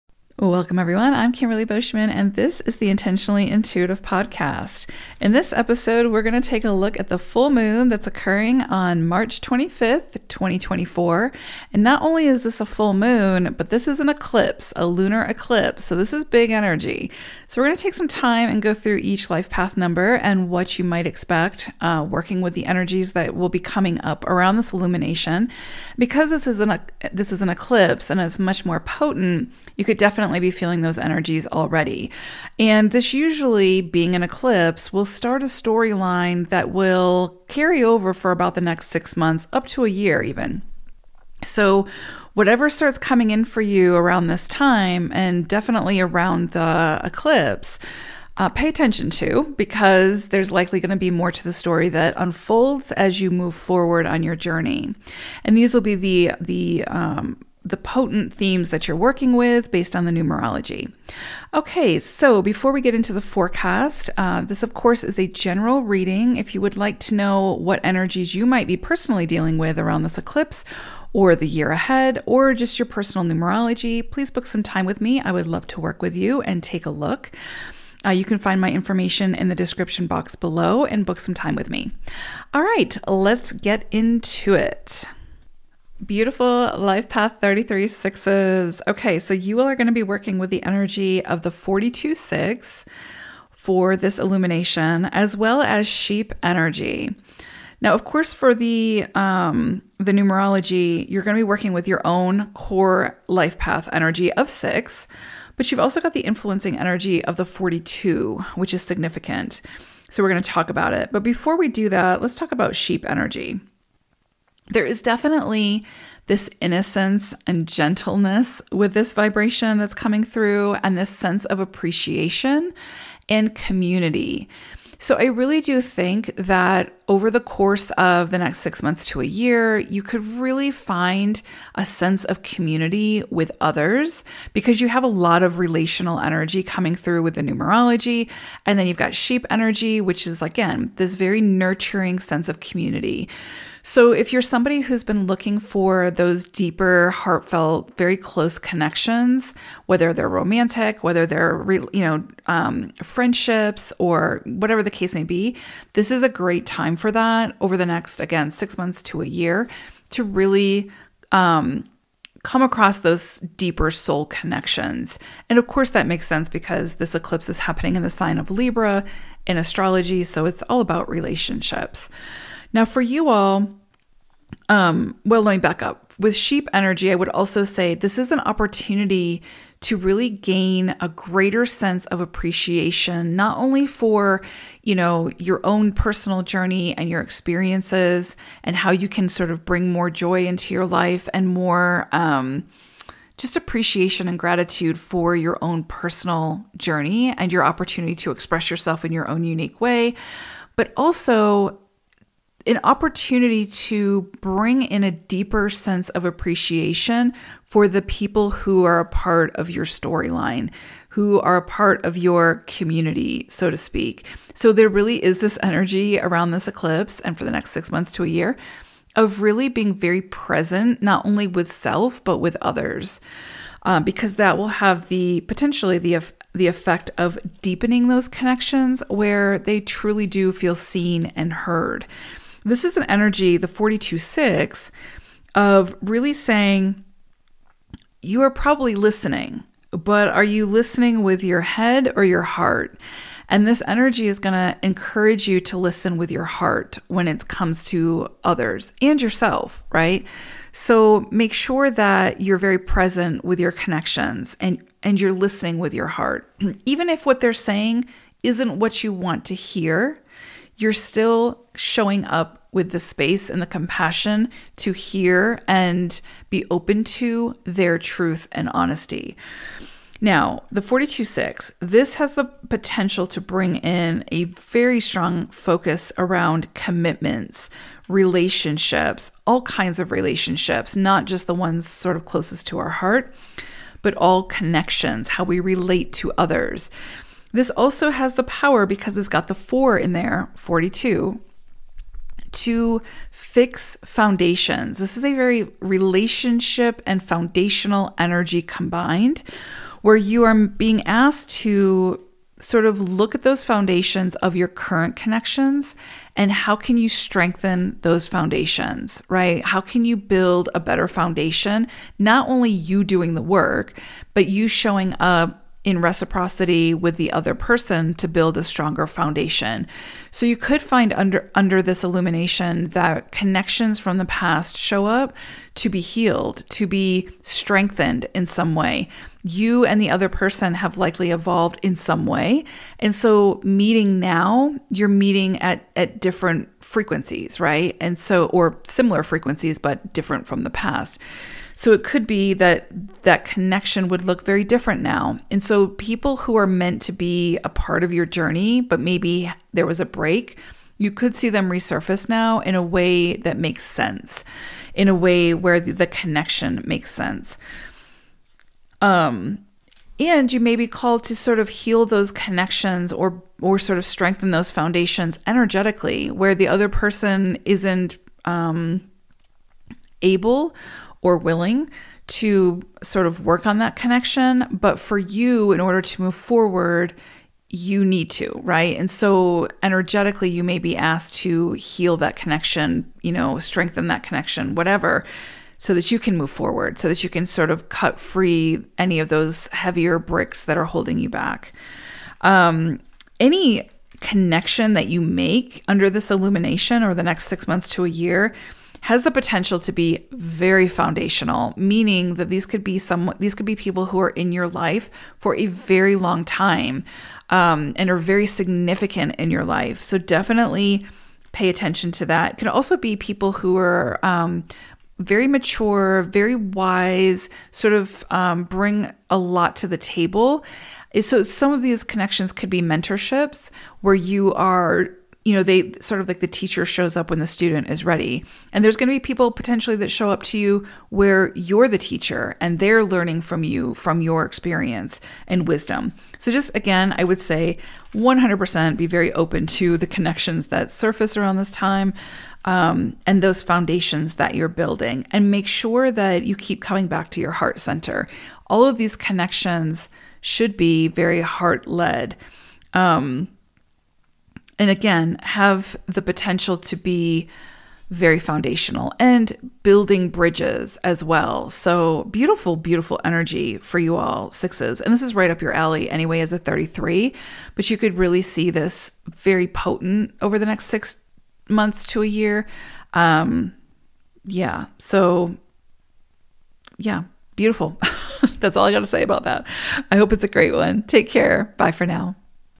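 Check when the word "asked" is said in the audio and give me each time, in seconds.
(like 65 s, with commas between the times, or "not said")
301 s, 380 s.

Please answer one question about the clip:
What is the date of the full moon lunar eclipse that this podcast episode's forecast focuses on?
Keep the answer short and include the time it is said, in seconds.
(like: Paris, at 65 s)
March 25th, 2024, at 9 s.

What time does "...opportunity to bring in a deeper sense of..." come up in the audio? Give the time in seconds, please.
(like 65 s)
202 s.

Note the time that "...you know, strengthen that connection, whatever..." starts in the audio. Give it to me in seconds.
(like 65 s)
383 s.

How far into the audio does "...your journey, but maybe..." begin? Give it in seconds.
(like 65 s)
348 s.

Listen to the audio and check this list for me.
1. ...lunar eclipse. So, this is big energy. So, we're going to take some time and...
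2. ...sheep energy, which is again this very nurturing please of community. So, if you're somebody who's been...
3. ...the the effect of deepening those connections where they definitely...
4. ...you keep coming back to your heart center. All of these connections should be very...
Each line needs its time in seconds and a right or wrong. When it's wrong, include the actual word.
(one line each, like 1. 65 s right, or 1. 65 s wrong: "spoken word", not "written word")
1. 14 s right
2. 139 s wrong: "sense", not "please"
3. 225 s wrong: "truly", not "definitely"
4. 446 s right.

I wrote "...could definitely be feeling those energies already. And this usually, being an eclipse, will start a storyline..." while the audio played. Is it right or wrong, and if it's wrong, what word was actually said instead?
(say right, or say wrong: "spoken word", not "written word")
right.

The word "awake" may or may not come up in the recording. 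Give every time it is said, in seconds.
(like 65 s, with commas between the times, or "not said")
not said.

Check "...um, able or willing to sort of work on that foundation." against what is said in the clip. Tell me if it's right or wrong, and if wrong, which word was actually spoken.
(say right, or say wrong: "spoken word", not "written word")
wrong: "connection", not "foundation".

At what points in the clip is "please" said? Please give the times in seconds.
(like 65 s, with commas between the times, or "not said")
74 s.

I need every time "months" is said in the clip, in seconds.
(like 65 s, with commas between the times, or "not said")
39 s, 128 s, 158 s, 217 s, 397 s, 471 s.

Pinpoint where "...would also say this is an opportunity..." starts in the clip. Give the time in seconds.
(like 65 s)
177 s.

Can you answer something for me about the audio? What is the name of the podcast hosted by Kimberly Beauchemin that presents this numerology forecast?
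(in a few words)
Intentionally Intuitive Podcast.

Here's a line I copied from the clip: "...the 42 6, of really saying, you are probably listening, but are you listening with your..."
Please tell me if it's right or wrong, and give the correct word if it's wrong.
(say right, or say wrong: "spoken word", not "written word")
right.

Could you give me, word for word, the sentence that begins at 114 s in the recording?
There is definitely this innocence and gentleness with this vibration that's coming through, and this sense of appreciation and community.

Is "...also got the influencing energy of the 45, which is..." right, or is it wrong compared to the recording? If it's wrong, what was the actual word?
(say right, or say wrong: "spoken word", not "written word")
wrong: "42", not "45".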